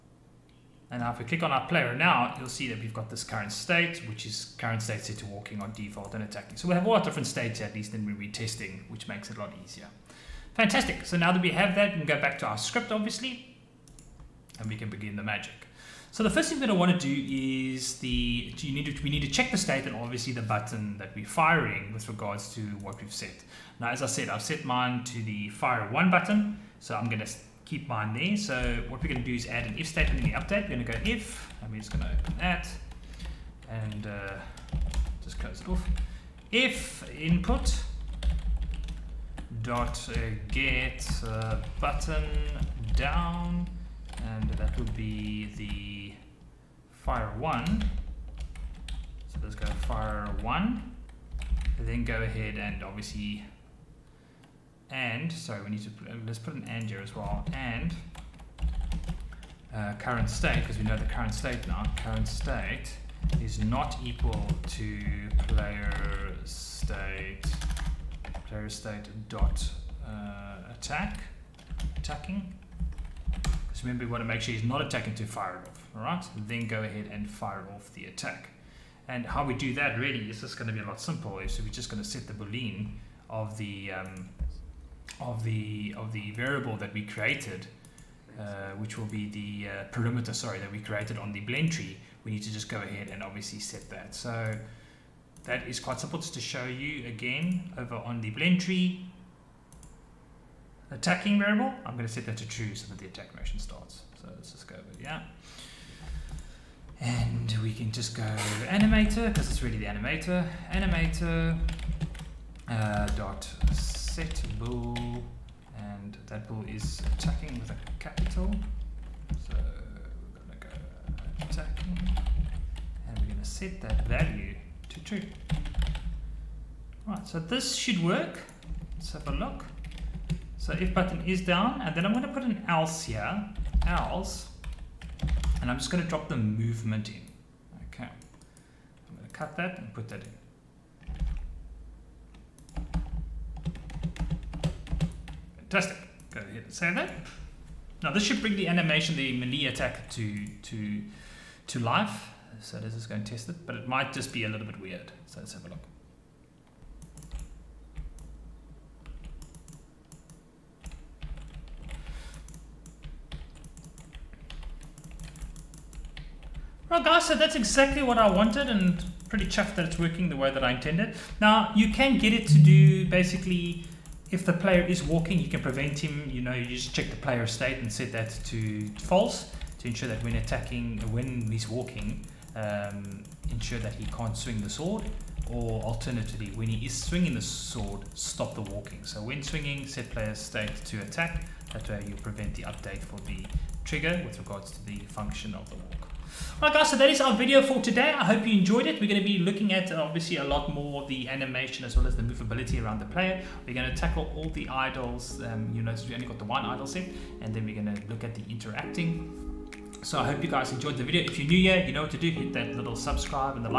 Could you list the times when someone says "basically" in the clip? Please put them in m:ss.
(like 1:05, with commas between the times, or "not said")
2:53.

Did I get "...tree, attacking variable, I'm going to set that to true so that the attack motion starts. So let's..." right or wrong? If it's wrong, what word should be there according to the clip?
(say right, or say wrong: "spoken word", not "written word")
right.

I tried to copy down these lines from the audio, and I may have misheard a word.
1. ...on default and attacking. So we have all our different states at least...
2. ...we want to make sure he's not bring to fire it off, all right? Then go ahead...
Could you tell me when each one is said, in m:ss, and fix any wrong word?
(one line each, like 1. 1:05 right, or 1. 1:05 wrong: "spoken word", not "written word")
1. 0:05 right
2. 1:14 wrong: "attacking", not "bring".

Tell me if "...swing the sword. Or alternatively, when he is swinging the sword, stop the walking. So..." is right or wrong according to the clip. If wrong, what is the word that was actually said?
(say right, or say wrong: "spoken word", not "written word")
right.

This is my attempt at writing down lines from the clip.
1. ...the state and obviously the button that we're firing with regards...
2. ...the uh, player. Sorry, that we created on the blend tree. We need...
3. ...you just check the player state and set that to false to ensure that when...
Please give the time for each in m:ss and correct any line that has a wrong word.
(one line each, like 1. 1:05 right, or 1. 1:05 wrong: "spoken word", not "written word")
1. 0:19 right
2. 1:29 wrong: "perimeter", not "player"
3. 2:56 right.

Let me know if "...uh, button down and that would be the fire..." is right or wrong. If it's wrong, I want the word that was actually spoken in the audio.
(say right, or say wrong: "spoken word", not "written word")
right.